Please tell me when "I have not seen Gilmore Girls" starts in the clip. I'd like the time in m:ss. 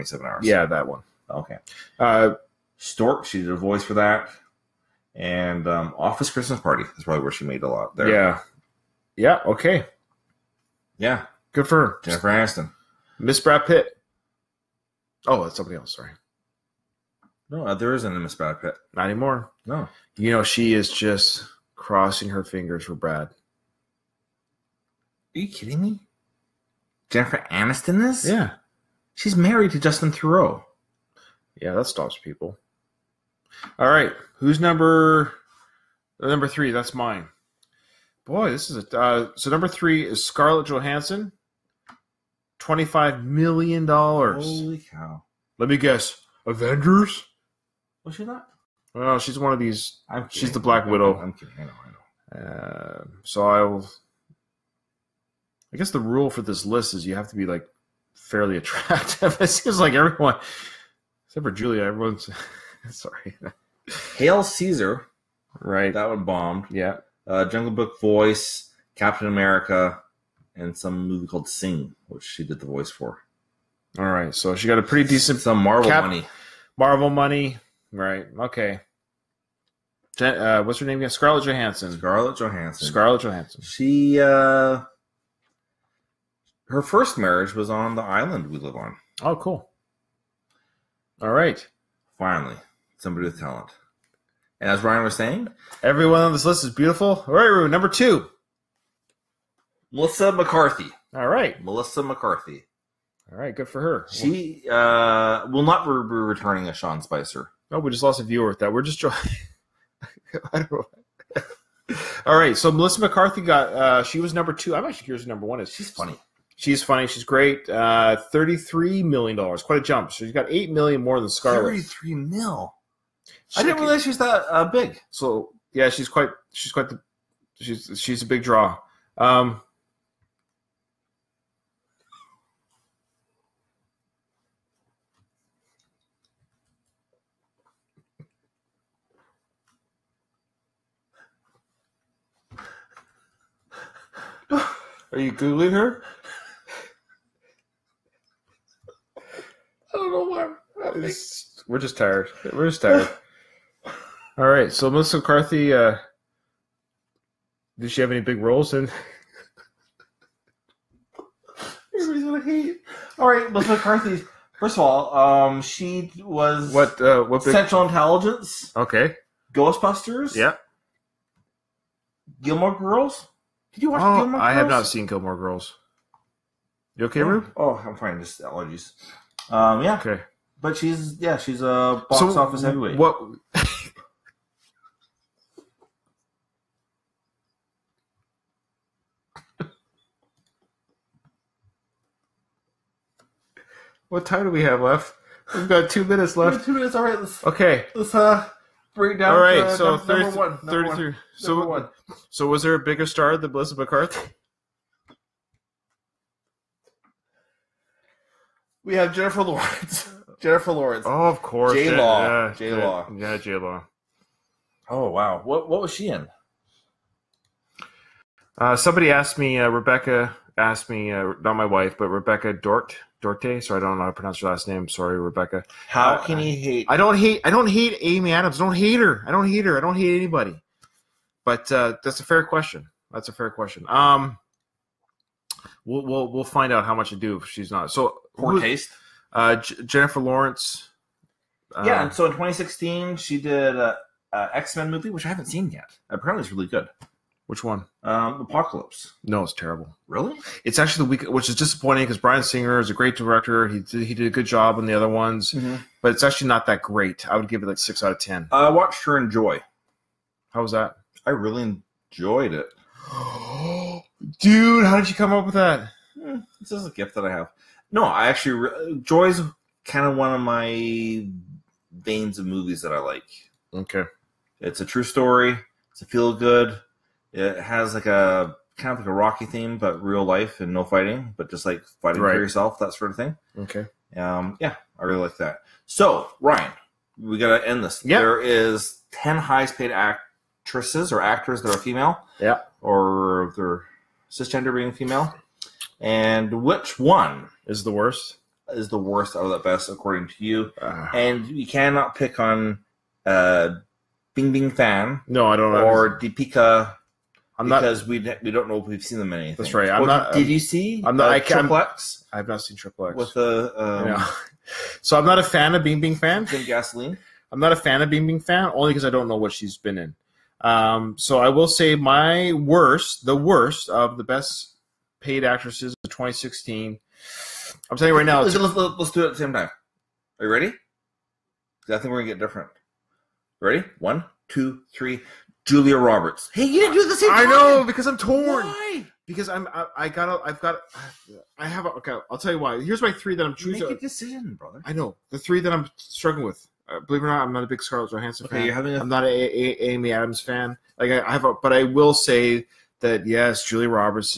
2:54.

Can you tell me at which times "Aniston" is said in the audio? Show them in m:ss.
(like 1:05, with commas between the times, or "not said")
0:12, 0:27.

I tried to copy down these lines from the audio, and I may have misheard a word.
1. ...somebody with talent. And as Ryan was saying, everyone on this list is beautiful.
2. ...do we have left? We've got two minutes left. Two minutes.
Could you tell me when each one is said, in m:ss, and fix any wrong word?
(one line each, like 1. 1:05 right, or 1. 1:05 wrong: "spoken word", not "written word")
1. 1:32 right
2. 3:14 right.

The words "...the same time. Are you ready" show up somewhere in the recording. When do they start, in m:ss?
5:29.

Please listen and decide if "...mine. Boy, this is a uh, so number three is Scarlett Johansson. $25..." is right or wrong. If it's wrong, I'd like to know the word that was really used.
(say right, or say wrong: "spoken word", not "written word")
right.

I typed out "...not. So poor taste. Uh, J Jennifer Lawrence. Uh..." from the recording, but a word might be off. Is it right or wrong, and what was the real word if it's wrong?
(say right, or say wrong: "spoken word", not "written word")
right.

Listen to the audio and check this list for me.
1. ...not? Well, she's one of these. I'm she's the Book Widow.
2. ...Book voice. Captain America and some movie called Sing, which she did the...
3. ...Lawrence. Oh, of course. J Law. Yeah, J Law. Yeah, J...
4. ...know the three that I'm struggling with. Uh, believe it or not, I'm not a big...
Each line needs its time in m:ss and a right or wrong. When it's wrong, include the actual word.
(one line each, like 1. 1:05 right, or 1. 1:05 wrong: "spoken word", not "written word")
1. 0:48 wrong: "Black", not "Book"
2. 1:07 right
3. 3:30 right
4. 5:44 right.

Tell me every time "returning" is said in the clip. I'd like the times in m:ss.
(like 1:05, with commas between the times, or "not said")
1:45.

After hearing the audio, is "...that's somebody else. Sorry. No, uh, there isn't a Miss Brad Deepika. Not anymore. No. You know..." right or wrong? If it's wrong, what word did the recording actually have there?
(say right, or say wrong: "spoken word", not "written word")
wrong: "Pitt", not "Deepika".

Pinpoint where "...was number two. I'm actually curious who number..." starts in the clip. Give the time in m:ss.
1:54.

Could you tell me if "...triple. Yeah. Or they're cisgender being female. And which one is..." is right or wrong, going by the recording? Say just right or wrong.
wrong.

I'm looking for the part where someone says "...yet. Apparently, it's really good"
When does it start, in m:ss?
4:05.